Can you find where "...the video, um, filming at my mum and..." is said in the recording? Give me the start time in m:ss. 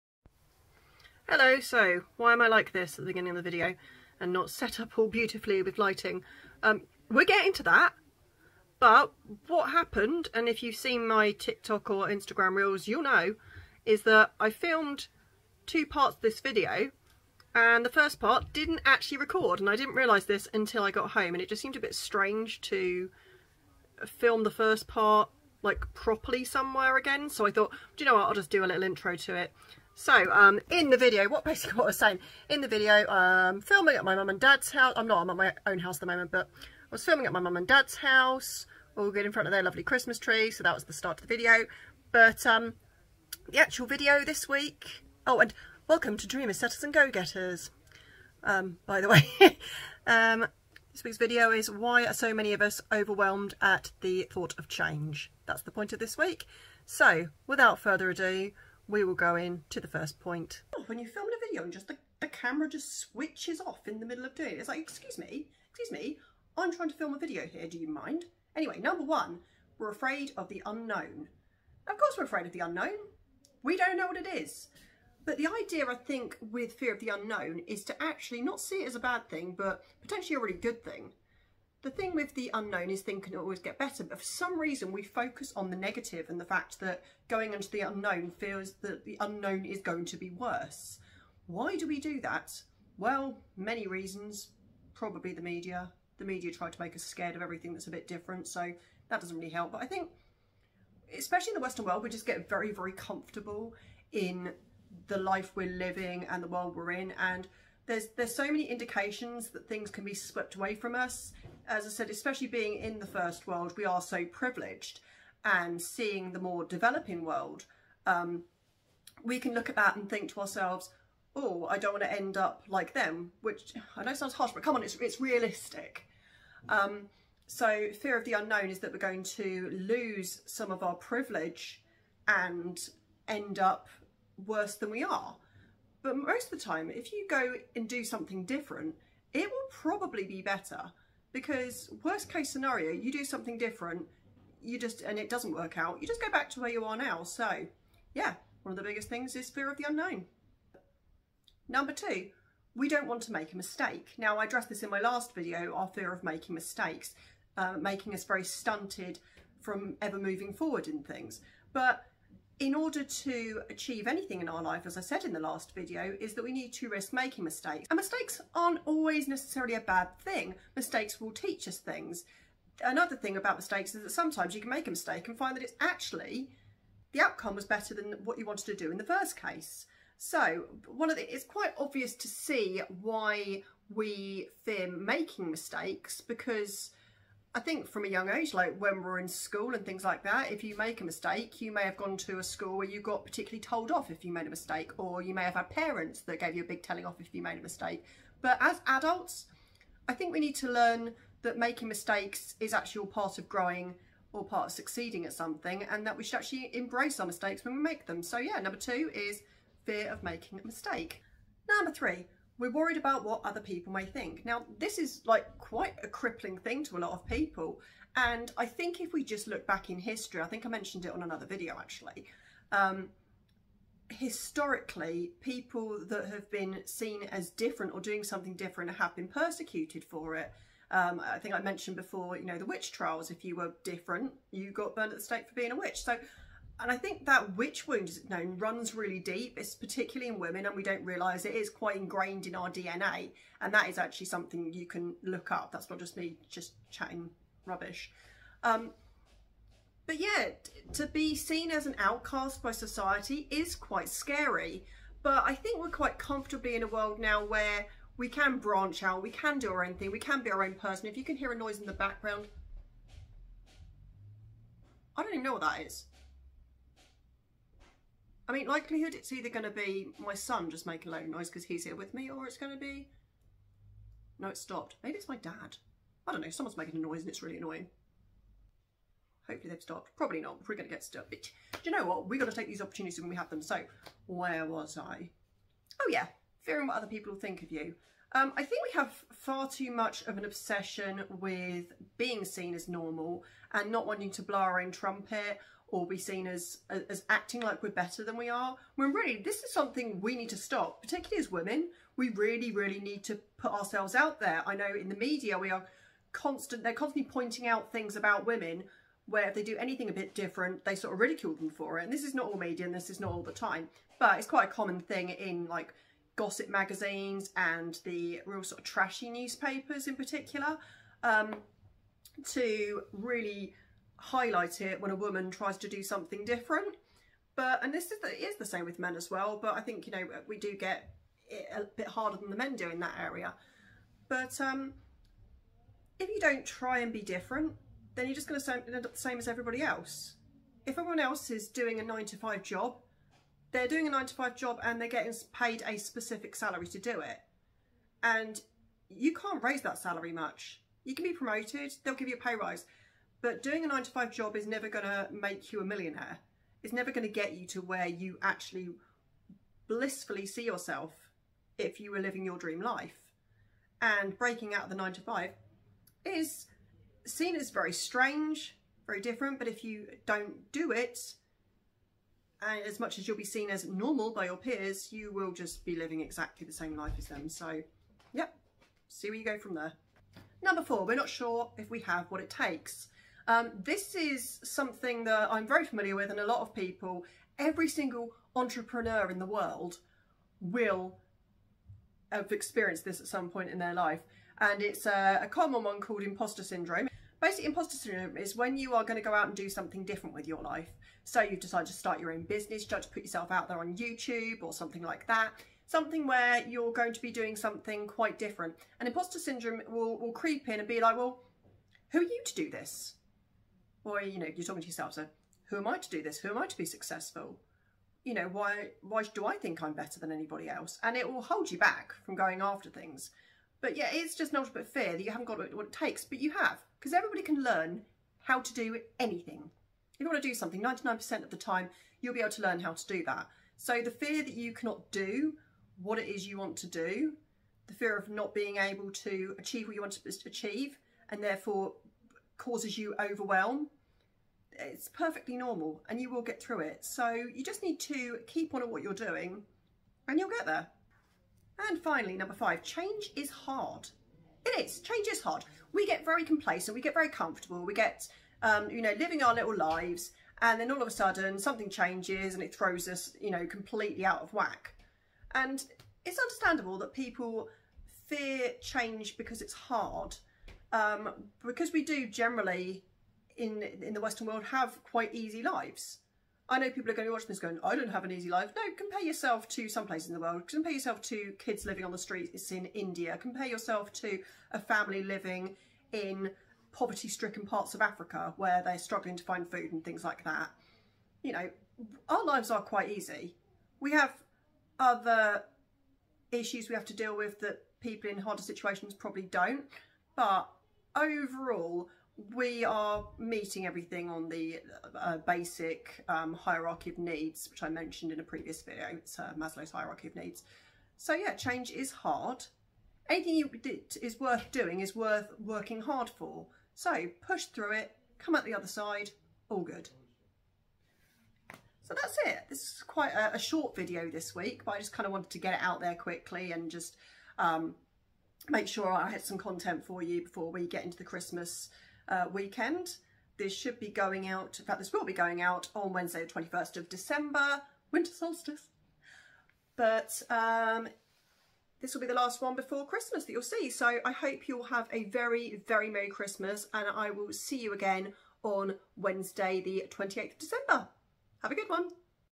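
0:32.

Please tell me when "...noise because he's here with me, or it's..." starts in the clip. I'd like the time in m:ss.
4:31.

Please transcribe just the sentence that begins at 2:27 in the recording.
So yeah, one of the biggest things is fear of the unknown.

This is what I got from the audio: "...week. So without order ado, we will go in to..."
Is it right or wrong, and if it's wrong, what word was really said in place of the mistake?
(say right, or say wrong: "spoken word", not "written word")
wrong: "further", not "order".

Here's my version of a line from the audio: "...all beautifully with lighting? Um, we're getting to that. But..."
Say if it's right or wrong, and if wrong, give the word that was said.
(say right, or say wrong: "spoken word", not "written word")
right.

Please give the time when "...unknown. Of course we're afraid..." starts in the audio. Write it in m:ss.
1:10.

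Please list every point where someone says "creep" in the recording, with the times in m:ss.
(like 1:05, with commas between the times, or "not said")
6:50.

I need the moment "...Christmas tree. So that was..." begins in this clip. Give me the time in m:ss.
0:39.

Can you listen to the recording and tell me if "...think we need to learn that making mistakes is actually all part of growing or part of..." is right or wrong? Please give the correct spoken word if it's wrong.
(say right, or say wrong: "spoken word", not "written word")
right.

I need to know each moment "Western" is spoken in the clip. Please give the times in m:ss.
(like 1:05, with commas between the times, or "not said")
1:41, 7:54.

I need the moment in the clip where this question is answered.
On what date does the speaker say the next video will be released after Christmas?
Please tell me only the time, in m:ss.
9:09.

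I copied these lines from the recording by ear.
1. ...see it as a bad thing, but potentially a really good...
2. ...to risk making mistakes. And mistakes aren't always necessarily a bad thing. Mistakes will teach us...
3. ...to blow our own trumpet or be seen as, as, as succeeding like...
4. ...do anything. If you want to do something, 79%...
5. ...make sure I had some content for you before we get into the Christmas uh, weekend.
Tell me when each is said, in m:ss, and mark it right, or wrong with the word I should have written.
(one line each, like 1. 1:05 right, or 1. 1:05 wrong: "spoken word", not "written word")
1. 1:18 right
2. 2:46 right
3. 4:54 wrong: "acting", not "succeeding"
4. 7:08 wrong: "99", not "79"
5. 8:48 right.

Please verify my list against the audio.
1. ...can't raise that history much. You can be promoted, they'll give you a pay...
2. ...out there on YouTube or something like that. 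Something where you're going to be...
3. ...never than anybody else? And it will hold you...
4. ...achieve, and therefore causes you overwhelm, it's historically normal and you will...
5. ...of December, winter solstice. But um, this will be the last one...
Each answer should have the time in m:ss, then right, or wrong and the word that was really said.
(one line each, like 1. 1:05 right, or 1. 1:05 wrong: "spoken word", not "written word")
1. 5:49 wrong: "salary", not "history"
2. 6:43 right
3. 6:59 wrong: "better", not "never"
4. 7:20 wrong: "perfectly", not "historically"
5. 8:56 right.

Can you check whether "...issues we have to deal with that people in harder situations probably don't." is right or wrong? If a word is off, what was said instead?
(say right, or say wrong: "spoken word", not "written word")
right.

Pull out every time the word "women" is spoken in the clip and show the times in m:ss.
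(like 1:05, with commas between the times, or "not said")
4:00, 5:01, 5:08.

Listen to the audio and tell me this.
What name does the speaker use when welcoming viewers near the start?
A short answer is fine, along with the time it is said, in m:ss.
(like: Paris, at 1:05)
Dreamers, Setters and Go-Getters, at 0:46.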